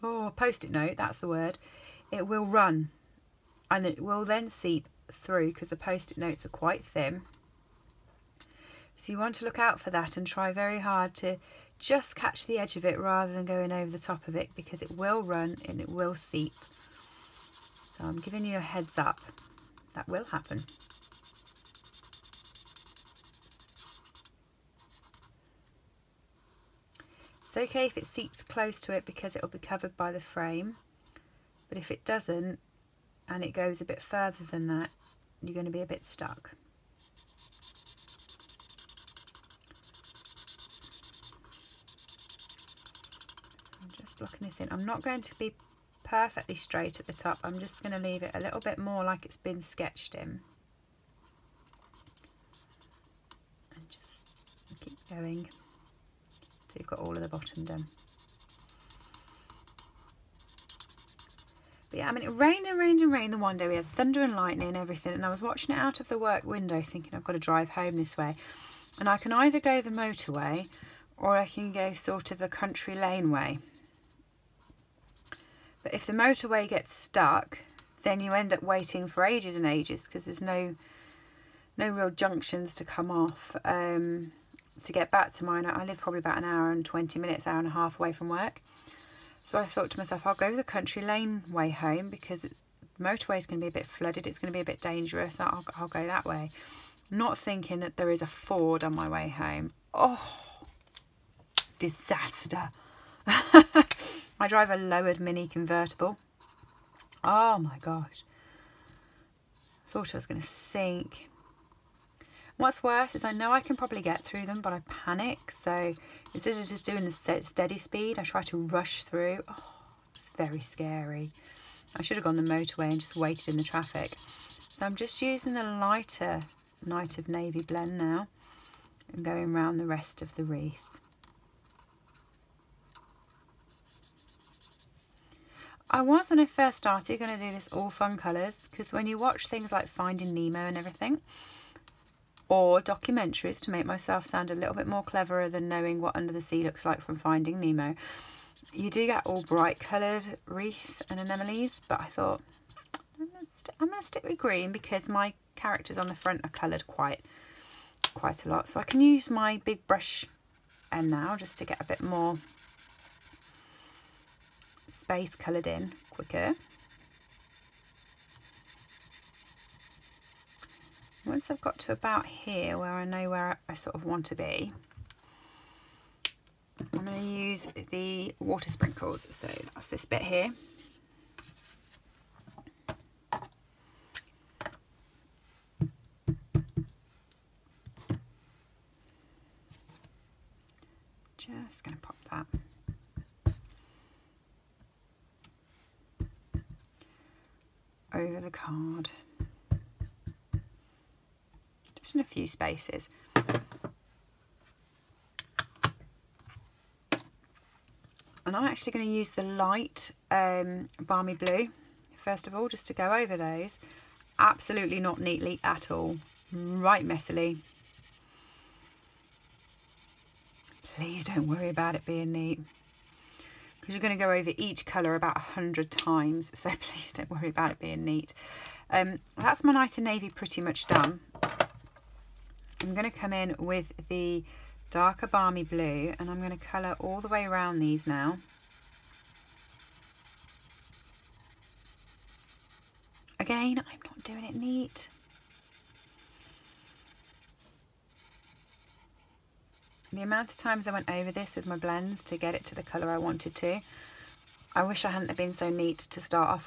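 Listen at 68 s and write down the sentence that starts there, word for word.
And I can either go the motorway or I can go sort of a country lane way.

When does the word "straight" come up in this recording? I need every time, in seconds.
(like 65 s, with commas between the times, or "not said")
46 s.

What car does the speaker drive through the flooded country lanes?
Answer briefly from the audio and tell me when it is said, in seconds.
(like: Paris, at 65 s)
lowered mini convertible, at 104 s.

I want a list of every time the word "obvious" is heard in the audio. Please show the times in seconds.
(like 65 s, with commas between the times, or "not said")
not said.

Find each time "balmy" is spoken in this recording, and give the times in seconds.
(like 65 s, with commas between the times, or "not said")
211 s, 235 s.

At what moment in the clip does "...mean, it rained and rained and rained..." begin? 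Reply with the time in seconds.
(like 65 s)
62 s.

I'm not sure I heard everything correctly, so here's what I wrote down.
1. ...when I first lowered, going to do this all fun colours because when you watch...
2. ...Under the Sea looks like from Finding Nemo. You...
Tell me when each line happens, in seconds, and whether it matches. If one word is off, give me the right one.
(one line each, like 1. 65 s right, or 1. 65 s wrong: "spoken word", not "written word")
1. 136 s wrong: "started", not "lowered"
2. 146 s right.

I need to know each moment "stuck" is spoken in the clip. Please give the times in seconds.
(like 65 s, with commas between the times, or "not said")
36 s, 76 s.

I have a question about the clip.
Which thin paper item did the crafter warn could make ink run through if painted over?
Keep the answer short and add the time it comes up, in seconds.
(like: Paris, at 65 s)
post-it note, at 0 s.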